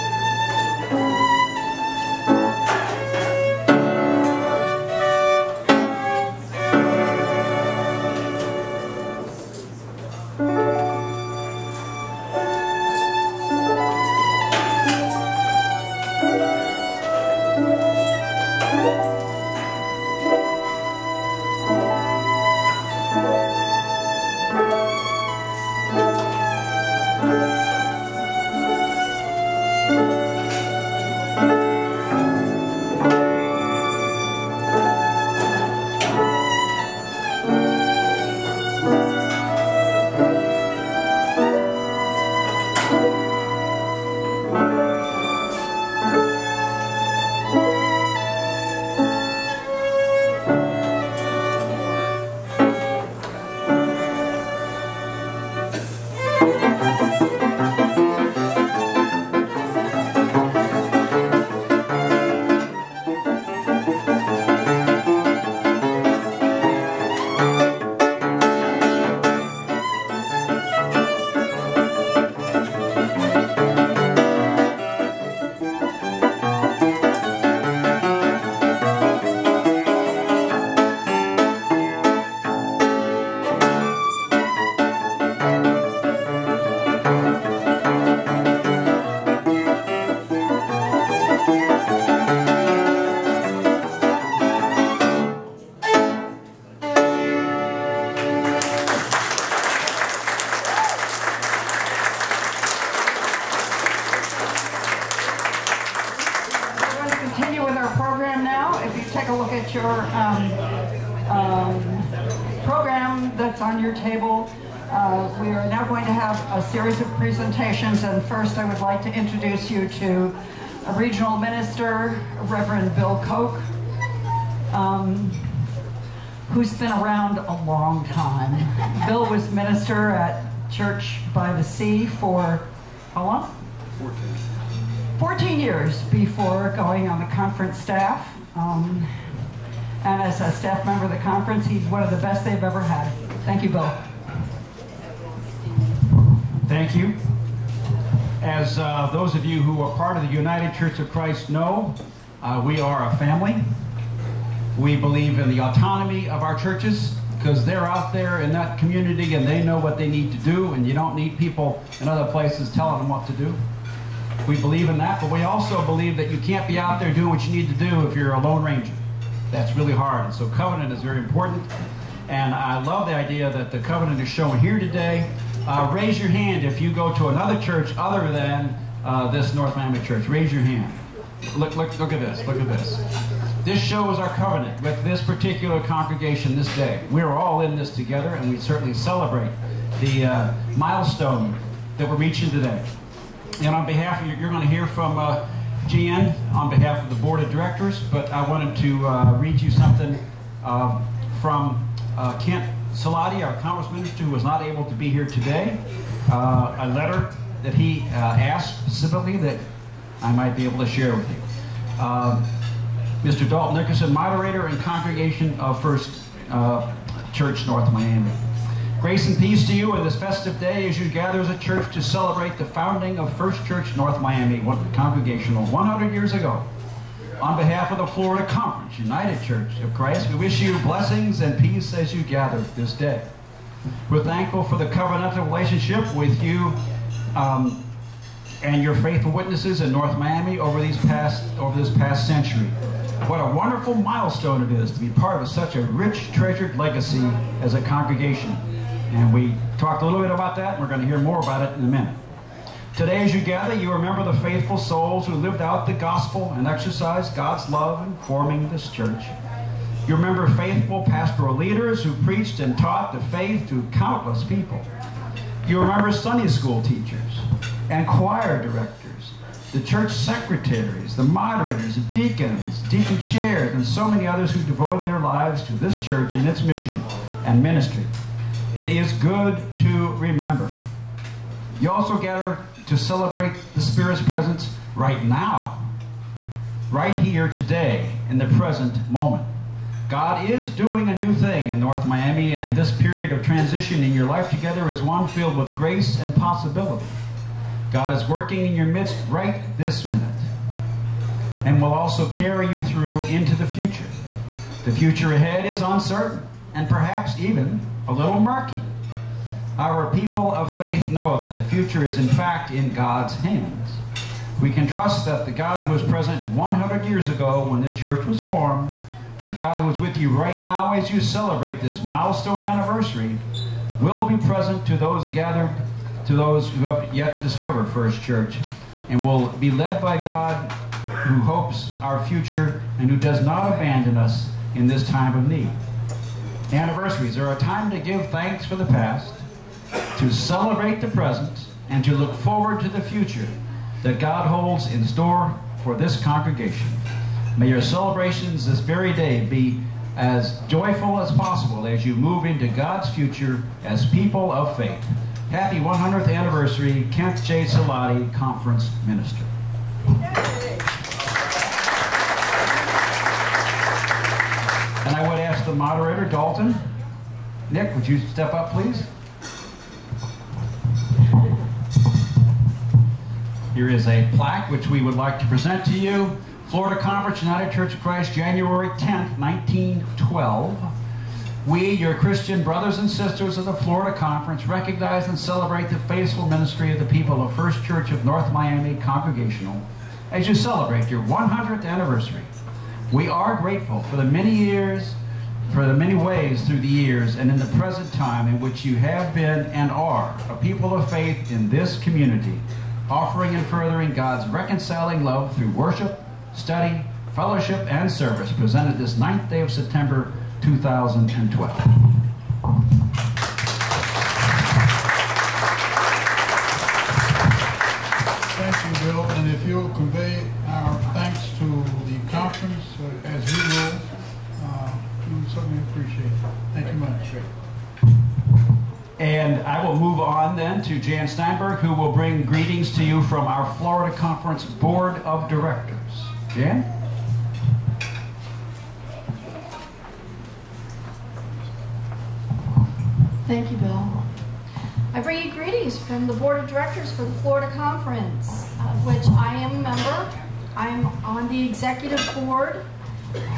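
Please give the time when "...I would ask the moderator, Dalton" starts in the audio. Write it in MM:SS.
06:05.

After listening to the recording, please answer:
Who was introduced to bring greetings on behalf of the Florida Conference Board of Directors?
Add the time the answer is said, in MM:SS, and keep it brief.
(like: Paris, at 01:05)
Jan Steinberg, at 07:10.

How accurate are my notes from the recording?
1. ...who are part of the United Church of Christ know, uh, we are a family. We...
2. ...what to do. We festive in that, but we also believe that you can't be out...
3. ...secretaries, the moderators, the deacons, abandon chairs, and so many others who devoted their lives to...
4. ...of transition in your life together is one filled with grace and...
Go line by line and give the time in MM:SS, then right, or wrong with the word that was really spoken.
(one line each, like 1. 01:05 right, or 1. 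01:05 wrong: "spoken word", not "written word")
1. 02:29 right
2. 02:43 wrong: "believe", not "festive"
3. 04:30 wrong: "deacon", not "abandon"
4. 04:53 right.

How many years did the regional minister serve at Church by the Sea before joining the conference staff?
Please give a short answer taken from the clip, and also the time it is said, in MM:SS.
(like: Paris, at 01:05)
14, at 02:15.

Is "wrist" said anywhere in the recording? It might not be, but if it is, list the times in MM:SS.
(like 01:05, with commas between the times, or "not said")
not said.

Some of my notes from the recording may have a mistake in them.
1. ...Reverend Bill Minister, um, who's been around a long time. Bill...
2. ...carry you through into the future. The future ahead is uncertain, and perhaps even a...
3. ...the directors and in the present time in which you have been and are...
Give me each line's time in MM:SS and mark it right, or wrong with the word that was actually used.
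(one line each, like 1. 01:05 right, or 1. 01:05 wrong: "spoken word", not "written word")
1. 02:02 wrong: "Koch", not "Minister"
2. 05:02 right
3. 06:36 wrong: "years", not "directors".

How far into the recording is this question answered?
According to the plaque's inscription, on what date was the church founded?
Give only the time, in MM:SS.
06:18.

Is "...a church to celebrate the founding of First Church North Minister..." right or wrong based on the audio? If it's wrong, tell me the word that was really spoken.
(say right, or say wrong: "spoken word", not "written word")
wrong: "Miami", not "Minister".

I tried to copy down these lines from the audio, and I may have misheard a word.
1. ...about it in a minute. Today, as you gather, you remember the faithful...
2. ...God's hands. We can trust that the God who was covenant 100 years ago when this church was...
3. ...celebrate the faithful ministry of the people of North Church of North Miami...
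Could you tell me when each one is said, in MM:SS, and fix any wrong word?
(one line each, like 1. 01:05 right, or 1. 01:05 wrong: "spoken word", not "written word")
1. 04:11 right
2. 05:12 wrong: "present", not "covenant"
3. 06:25 wrong: "First", not "North".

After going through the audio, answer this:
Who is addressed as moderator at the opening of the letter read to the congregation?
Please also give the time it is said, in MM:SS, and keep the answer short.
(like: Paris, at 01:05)
Dalton Nickerson, at 03:33.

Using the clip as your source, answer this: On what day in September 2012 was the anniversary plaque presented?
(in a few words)
9th.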